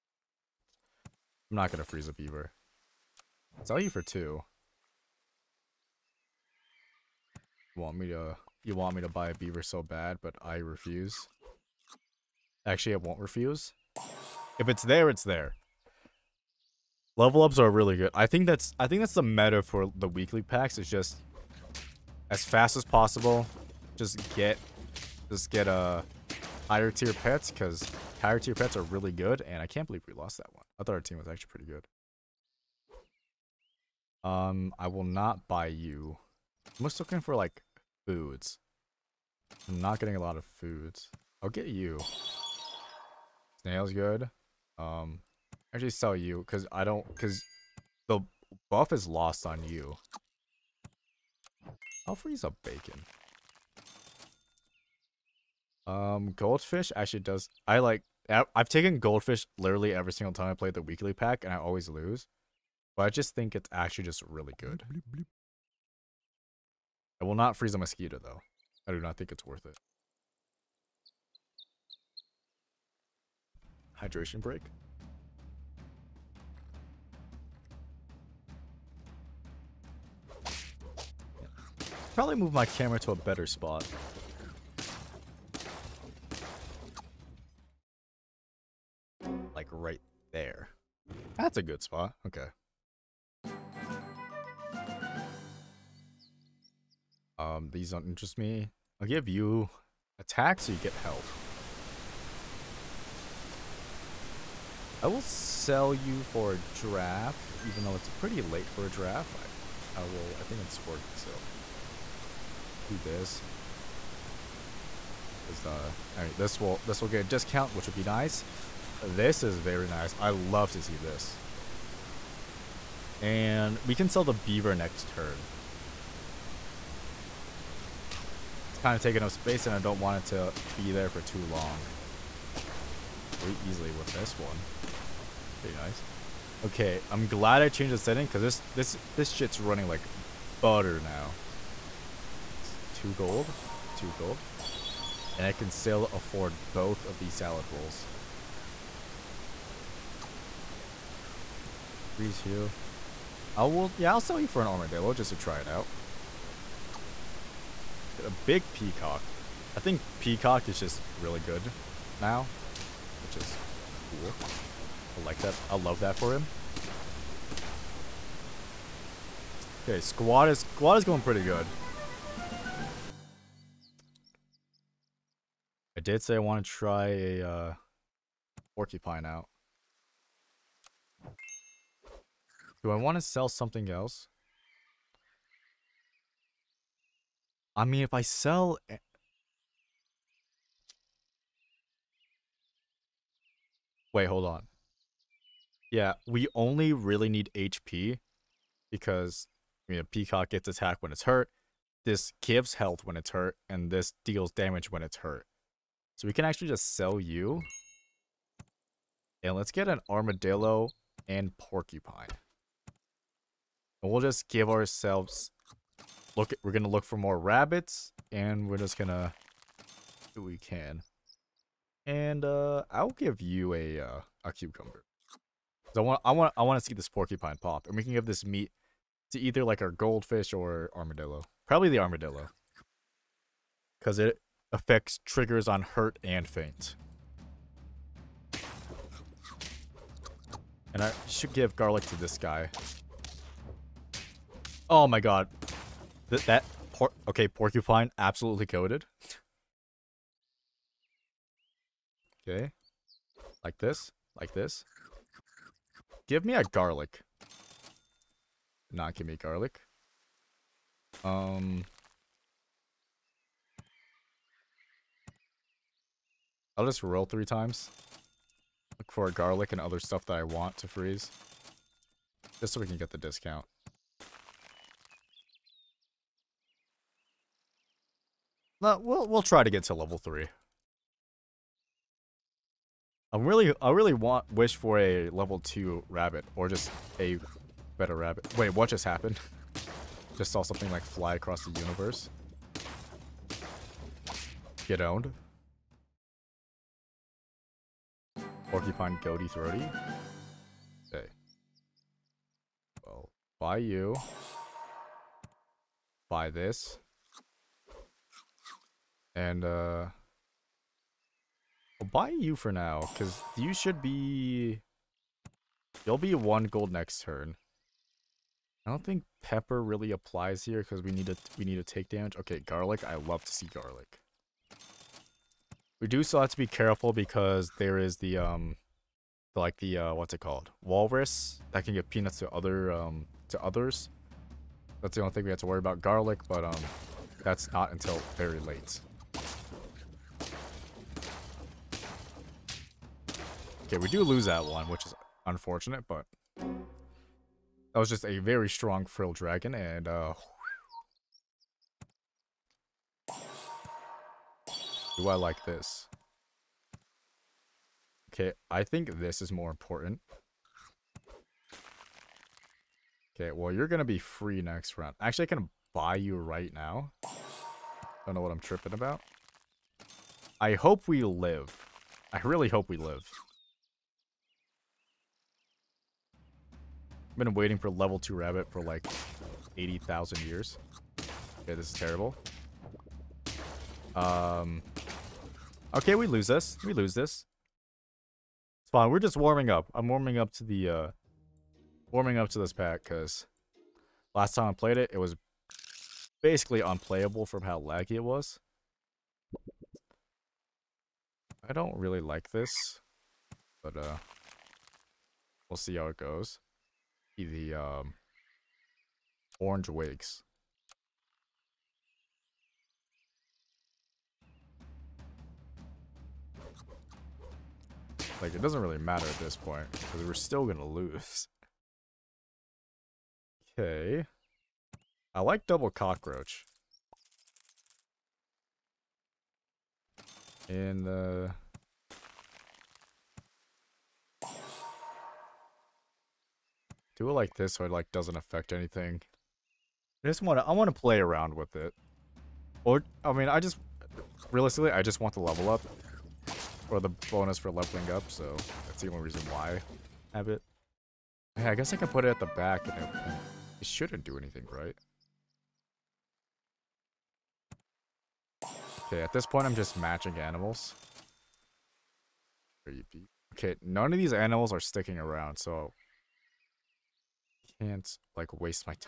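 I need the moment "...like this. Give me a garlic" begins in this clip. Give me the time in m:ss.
4:14.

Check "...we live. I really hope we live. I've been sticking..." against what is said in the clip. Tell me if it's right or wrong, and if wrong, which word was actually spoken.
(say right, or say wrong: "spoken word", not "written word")
wrong: "waiting", not "sticking".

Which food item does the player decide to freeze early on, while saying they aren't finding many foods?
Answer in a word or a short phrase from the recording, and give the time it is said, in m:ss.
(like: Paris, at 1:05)
bacon, at 0:52.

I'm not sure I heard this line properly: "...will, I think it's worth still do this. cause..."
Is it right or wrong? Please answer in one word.
right.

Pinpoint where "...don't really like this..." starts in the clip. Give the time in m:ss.
6:41.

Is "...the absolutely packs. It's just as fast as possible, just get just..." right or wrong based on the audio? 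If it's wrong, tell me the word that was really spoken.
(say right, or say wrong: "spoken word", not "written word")
wrong: "weekly", not "absolutely".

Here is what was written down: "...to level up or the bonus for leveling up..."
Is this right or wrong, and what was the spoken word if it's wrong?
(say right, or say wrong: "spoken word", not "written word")
right.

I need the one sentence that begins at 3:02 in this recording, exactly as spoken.
Do I want to sell something else?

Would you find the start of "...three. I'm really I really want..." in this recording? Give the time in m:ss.
4:40.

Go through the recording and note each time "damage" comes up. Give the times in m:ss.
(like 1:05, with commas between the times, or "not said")
3:24, 5:22.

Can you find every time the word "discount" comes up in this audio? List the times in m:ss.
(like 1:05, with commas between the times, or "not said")
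1:57, 4:33.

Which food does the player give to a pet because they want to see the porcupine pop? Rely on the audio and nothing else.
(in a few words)
cucumber.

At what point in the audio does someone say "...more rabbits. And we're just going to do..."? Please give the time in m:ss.
3:37.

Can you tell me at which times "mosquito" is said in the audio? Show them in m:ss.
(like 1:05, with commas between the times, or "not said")
1:07.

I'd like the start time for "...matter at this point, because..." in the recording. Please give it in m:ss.
6:58.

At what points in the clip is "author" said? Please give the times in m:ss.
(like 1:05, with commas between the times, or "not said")
not said.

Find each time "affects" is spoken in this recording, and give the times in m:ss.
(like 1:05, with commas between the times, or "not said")
3:54, 7:18.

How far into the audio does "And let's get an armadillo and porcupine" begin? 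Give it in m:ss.
3:29.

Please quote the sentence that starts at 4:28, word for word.
Look for garlic and other stuff that I want to freeze.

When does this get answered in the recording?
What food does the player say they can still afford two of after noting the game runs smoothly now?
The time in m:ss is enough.
2:27.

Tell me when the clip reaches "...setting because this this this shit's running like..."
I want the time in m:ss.
2:17.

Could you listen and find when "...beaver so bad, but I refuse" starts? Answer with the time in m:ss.
0:09.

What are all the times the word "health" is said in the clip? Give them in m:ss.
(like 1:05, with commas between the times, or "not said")
1:40, 3:22.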